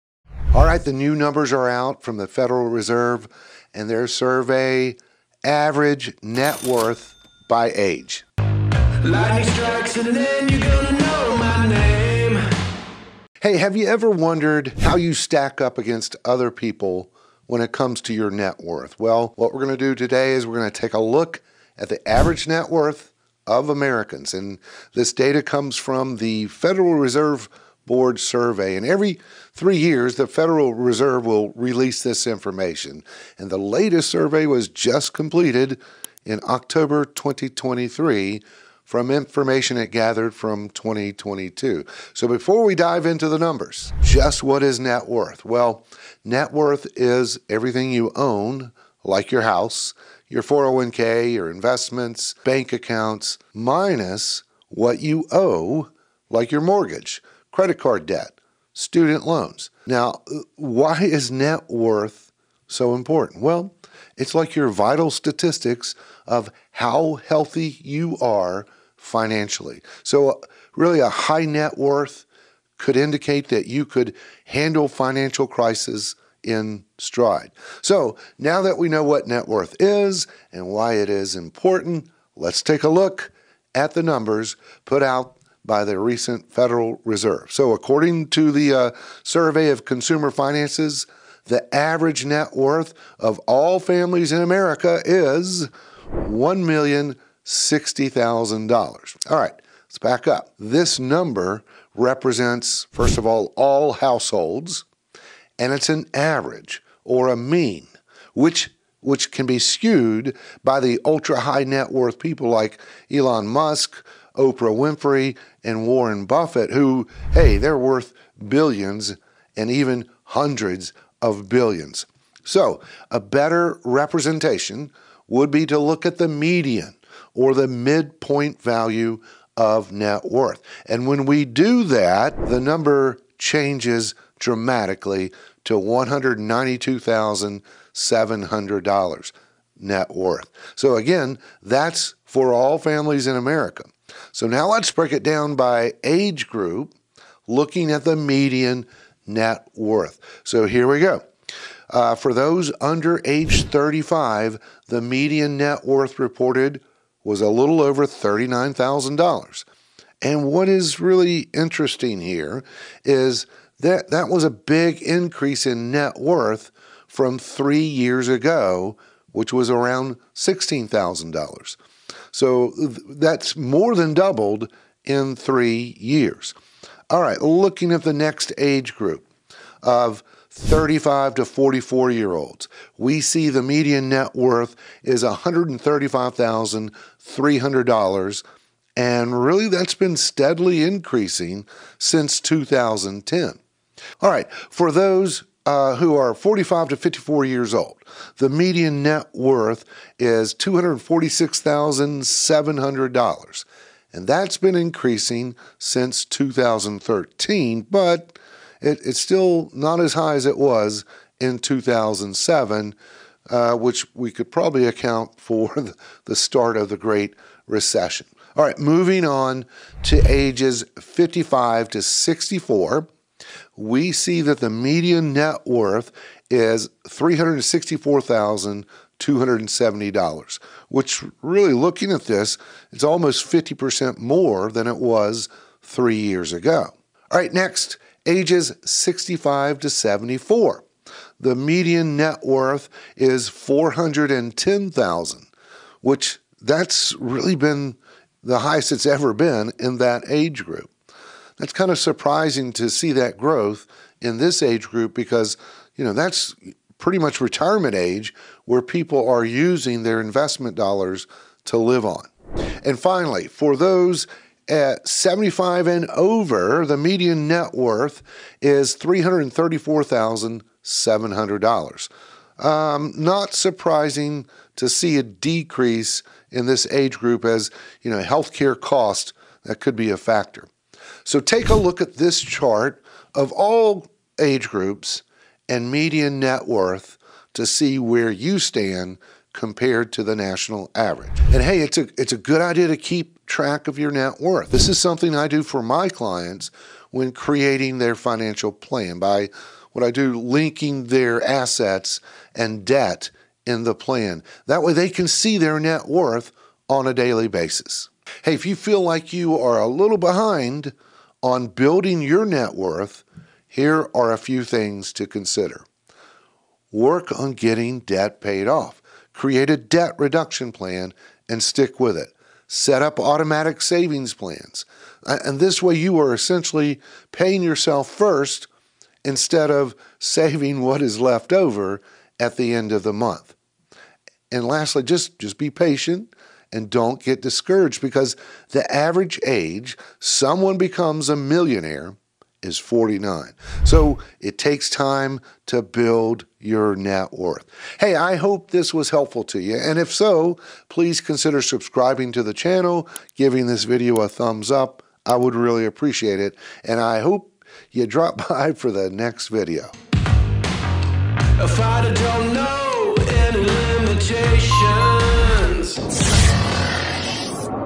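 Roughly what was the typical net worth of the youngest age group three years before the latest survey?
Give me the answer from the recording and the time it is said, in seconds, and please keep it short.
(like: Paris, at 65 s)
$16,000, at 170 s.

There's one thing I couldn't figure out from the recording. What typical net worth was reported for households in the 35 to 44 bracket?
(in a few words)
$135,300.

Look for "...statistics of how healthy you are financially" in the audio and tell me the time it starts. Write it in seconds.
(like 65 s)
65 s.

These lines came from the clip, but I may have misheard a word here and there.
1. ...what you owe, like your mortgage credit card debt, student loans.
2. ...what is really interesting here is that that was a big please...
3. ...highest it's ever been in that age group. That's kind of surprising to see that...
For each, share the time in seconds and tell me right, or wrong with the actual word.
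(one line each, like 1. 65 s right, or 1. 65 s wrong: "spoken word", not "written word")
1. 54 s right
2. 160 s wrong: "increase", not "please"
3. 248 s right.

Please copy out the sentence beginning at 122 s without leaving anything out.
So, a better representation would be to look at the median or the midpoint value of net worth.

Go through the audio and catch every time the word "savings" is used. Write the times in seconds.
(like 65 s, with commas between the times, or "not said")
323 s, 330 s.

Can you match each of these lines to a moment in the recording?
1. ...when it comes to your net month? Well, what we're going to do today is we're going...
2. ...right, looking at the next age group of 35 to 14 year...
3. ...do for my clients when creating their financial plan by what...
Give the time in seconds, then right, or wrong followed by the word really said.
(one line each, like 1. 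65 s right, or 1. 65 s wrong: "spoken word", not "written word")
1. 17 s wrong: "worth", not "month"
2. 177 s wrong: "44", not "14"
3. 295 s right.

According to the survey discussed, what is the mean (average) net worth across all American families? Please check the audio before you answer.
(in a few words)
$1,060,000.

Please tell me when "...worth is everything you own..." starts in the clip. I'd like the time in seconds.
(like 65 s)
46 s.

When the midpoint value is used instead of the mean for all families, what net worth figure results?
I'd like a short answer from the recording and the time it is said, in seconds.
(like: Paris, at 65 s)
$192,700, at 135 s.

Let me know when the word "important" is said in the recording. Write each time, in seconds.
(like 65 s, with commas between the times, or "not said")
62 s, 81 s.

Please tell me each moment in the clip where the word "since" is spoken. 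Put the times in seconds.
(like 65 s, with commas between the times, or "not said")
191 s, 205 s.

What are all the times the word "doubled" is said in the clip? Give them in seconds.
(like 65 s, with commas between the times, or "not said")
174 s.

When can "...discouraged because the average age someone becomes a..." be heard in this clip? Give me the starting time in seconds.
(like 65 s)
337 s.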